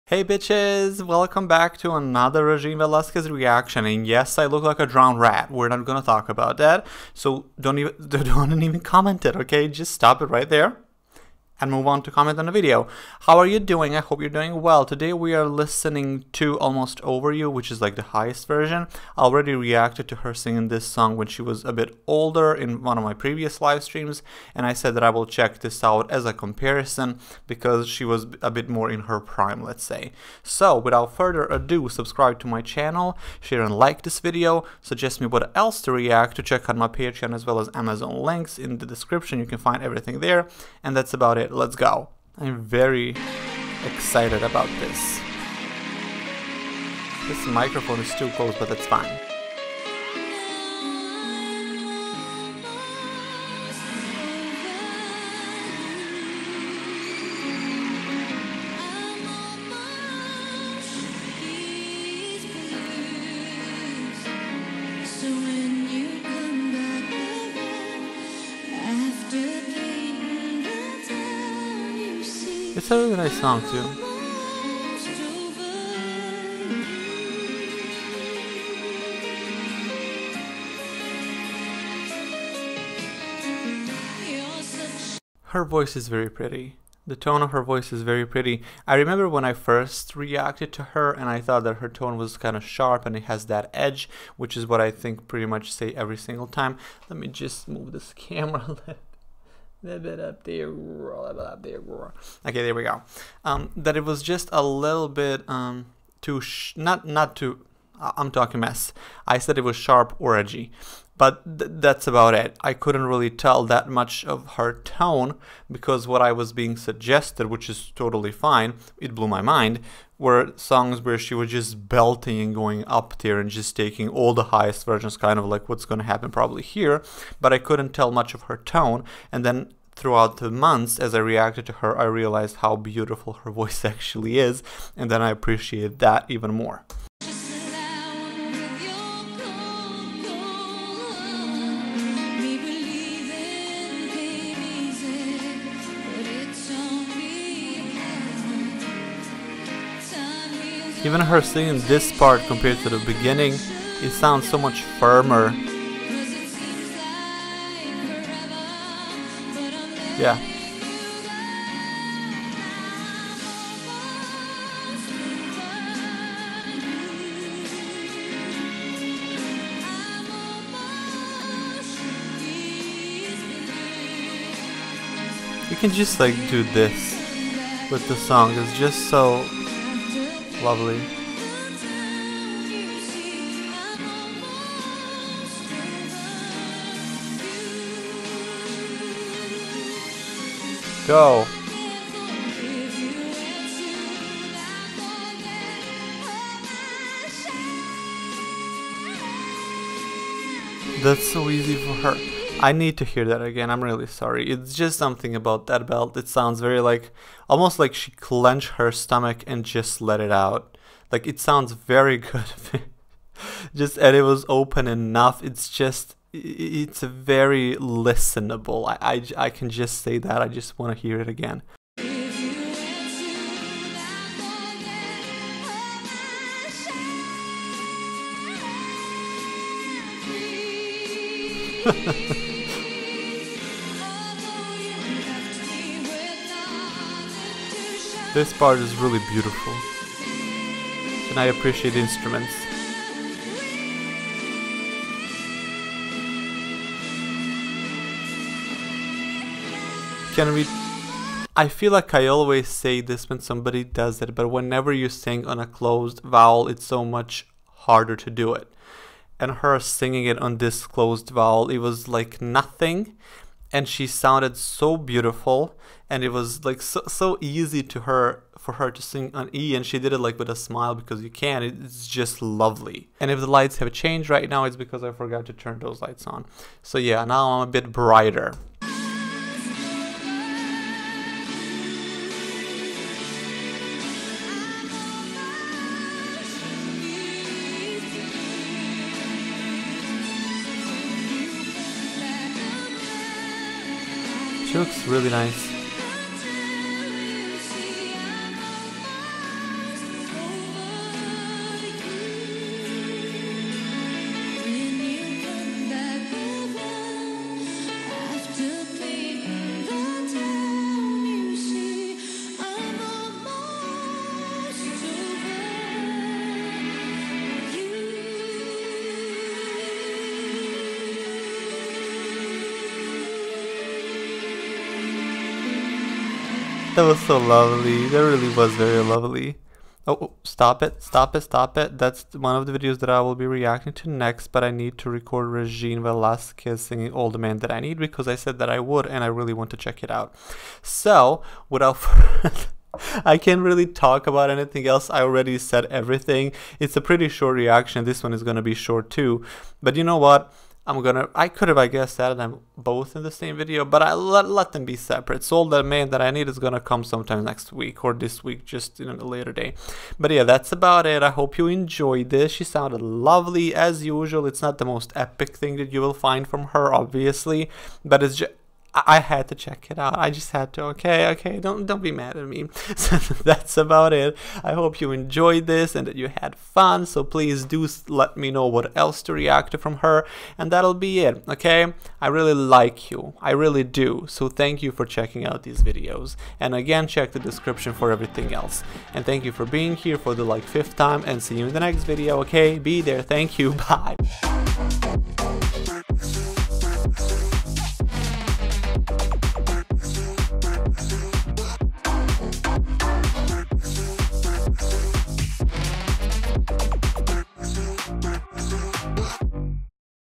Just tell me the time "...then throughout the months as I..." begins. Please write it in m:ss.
2:09.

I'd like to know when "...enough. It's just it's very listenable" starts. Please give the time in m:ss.
3:34.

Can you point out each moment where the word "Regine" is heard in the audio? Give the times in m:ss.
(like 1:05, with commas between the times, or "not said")
0:02, 5:35.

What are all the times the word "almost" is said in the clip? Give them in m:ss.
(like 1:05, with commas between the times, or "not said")
0:16, 3:27.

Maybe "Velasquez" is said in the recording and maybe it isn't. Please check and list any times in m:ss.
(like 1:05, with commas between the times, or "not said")
0:02, 5:36.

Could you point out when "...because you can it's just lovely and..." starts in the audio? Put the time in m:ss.
4:30.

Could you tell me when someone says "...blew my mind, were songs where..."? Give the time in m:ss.
1:59.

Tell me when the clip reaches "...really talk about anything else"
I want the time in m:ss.
5:43.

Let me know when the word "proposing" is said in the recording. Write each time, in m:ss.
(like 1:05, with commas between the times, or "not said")
not said.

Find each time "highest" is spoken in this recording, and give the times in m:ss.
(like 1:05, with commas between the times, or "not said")
0:18, 2:04.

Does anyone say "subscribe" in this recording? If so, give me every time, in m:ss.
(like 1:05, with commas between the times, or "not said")
0:31.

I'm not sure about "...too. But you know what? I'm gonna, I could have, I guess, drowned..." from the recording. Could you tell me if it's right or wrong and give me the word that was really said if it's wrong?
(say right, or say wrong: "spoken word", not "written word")
wrong: "added", not "drowned".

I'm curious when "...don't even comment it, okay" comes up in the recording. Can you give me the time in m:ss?
0:08.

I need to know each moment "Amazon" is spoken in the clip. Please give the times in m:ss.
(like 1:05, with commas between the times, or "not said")
0:37.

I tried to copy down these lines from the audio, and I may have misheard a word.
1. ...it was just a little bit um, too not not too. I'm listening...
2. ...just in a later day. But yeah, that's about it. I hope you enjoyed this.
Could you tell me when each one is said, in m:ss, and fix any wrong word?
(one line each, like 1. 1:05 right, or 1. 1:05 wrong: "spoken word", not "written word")
1. 1:43 wrong: "talking", not "listening"
2. 5:58 right.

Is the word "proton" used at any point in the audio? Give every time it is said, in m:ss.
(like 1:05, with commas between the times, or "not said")
not said.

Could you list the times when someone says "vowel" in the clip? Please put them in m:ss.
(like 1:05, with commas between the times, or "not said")
4:16, 4:21.